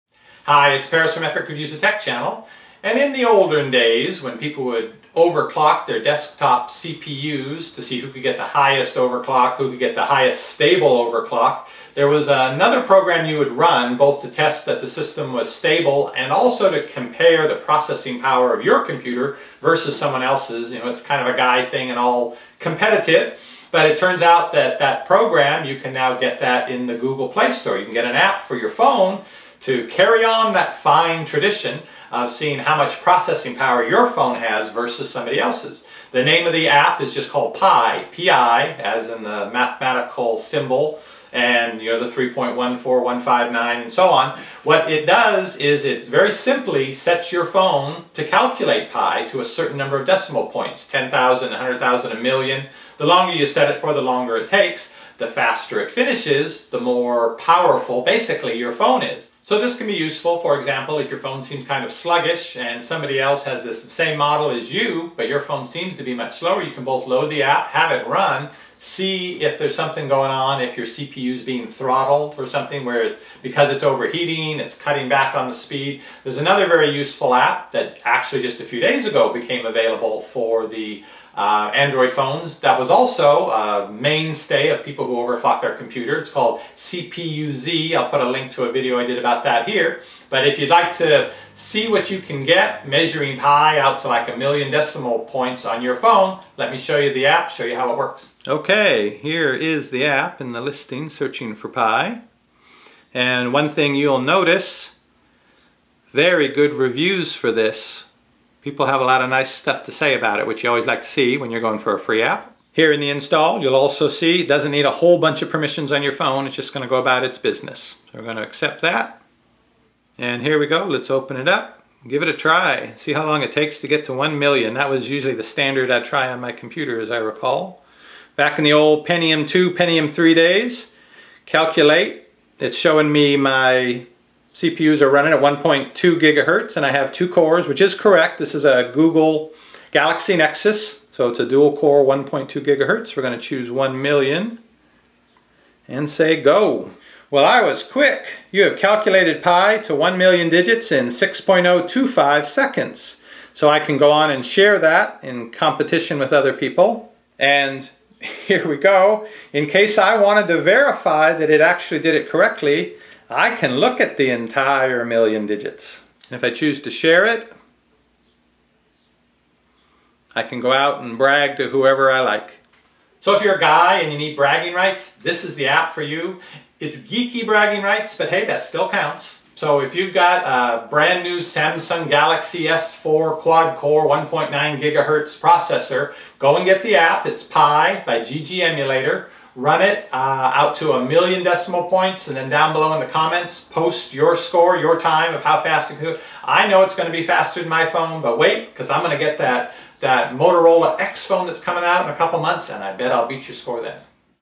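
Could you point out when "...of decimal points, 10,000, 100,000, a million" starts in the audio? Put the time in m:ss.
0:49.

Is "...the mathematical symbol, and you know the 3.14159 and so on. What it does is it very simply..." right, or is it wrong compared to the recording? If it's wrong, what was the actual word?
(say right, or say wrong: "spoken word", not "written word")
right.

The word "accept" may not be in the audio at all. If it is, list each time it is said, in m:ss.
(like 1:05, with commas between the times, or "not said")
1:58.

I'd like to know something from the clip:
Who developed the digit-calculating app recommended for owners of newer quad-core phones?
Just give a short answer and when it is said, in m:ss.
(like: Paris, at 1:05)
GG Emulator, at 3:08.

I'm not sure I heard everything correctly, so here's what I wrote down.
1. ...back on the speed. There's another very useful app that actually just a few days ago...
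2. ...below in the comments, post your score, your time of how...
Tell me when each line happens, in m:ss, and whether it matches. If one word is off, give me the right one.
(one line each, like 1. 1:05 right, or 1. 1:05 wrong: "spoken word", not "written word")
1. 1:15 right
2. 3:12 right.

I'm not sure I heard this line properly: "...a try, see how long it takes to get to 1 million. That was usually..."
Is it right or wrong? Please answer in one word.
right.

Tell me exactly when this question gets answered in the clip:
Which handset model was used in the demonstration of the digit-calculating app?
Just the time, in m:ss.
2:19.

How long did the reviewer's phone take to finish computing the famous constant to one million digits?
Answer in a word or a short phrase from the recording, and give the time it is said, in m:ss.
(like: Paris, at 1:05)
6.025 seconds, at 2:31.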